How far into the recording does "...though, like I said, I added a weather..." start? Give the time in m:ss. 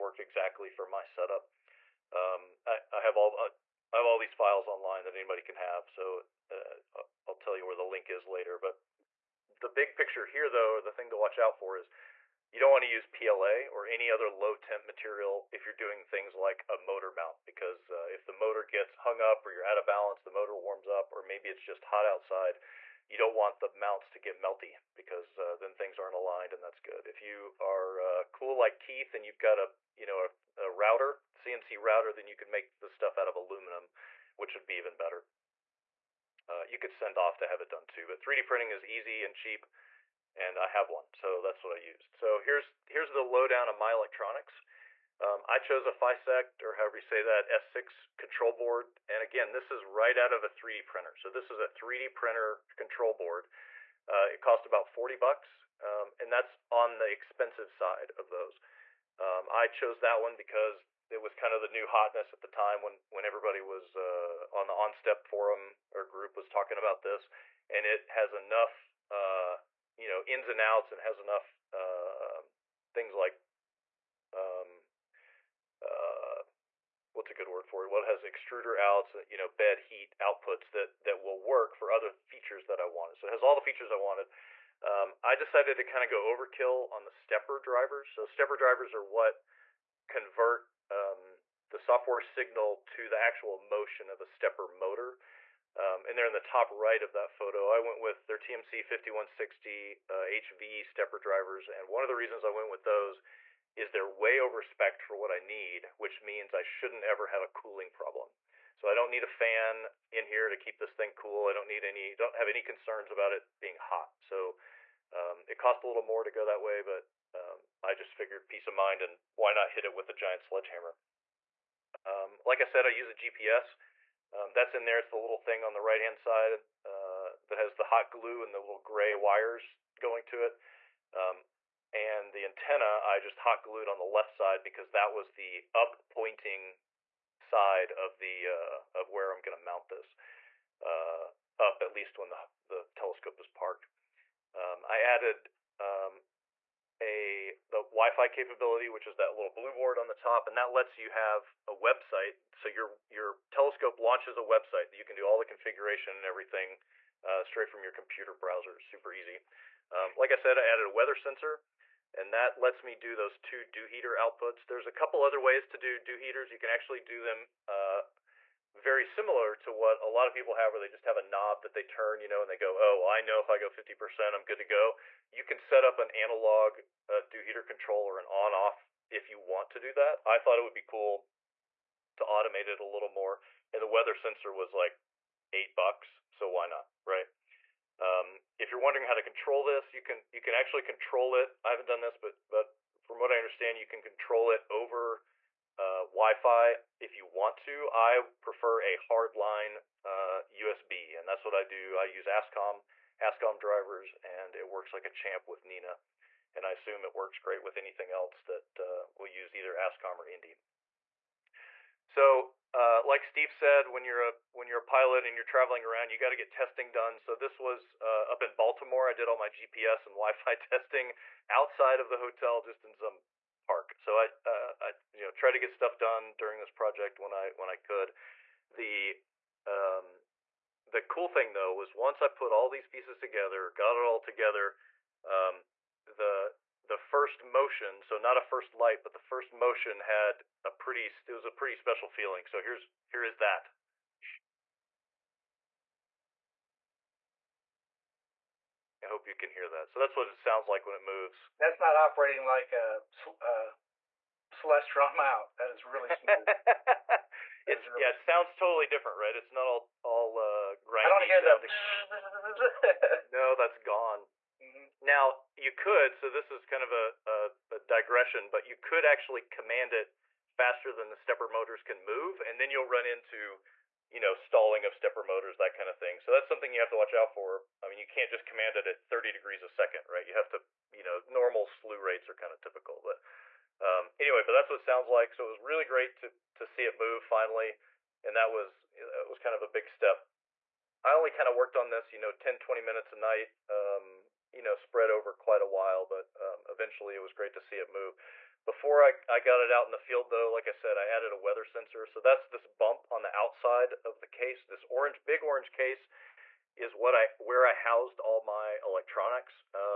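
5:00.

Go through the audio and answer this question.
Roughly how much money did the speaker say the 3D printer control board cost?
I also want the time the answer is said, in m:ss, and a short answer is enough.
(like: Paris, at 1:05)
40 bucks, at 0:54.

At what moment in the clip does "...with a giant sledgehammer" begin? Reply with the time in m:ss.
1:59.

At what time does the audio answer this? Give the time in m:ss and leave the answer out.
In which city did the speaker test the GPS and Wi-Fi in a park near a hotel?
3:38.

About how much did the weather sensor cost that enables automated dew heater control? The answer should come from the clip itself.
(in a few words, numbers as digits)
8 bucks.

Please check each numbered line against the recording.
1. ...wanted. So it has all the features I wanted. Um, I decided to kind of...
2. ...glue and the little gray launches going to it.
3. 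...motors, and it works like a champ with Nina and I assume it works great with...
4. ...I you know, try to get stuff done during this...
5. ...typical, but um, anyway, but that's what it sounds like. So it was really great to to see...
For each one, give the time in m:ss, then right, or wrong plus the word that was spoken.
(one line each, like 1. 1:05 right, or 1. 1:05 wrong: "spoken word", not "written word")
1. 1:22 right
2. 2:08 wrong: "wires", not "launches"
3. 3:23 wrong: "drivers", not "motors"
4. 3:44 right
5. 4:42 right.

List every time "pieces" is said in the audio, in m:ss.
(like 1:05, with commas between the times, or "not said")
3:52.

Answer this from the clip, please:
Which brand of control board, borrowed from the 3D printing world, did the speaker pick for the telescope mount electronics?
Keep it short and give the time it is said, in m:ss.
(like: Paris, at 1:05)
FYSETC, at 0:45.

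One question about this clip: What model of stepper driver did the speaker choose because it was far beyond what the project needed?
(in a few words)
TMC 5160 HV.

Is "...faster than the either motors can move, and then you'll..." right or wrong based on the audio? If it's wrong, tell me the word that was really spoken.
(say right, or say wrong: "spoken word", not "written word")
wrong: "stepper", not "either".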